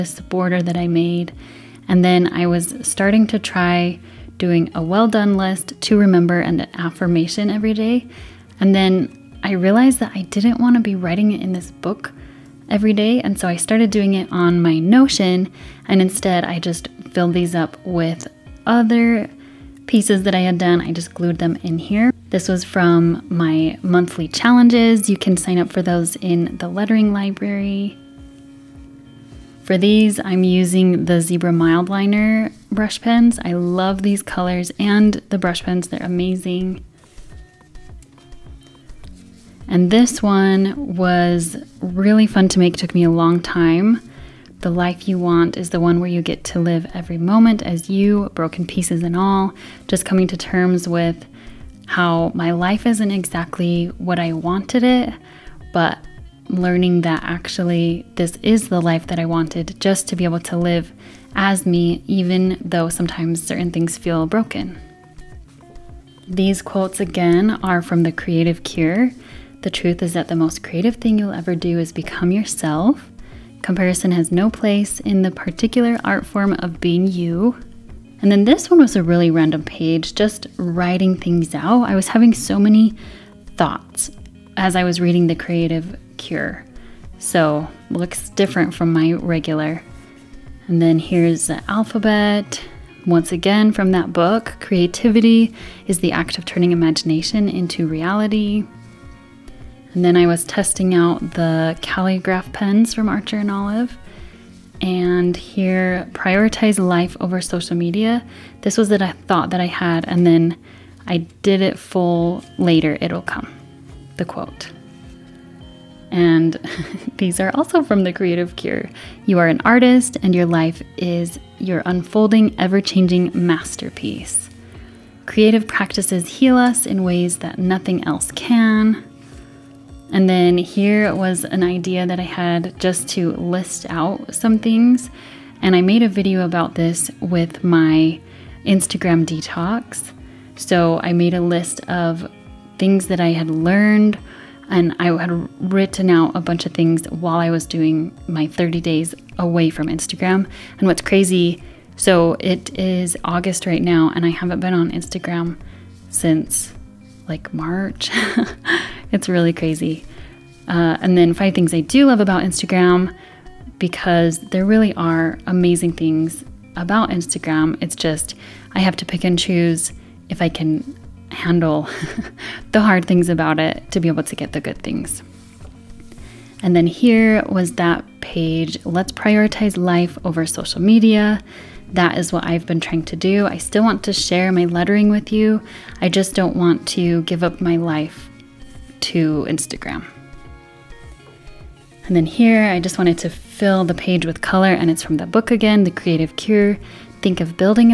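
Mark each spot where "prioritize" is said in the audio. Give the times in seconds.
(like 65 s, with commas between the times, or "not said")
106 s, 179 s.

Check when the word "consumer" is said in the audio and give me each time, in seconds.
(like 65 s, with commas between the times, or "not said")
not said.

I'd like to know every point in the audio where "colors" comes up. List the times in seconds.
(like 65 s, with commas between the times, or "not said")
34 s, 194 s.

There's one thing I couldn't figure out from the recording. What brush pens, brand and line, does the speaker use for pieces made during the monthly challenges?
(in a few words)
Zebra Mildliner.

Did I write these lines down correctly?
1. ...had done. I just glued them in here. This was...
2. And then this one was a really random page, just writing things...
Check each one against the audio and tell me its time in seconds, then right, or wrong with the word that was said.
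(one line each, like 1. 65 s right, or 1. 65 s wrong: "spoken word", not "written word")
1. 20 s right
2. 78 s right.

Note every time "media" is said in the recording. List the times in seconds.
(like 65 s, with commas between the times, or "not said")
107 s, 180 s.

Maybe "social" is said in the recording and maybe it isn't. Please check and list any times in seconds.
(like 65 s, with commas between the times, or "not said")
107 s, 180 s.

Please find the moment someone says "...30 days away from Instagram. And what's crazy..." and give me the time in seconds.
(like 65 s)
148 s.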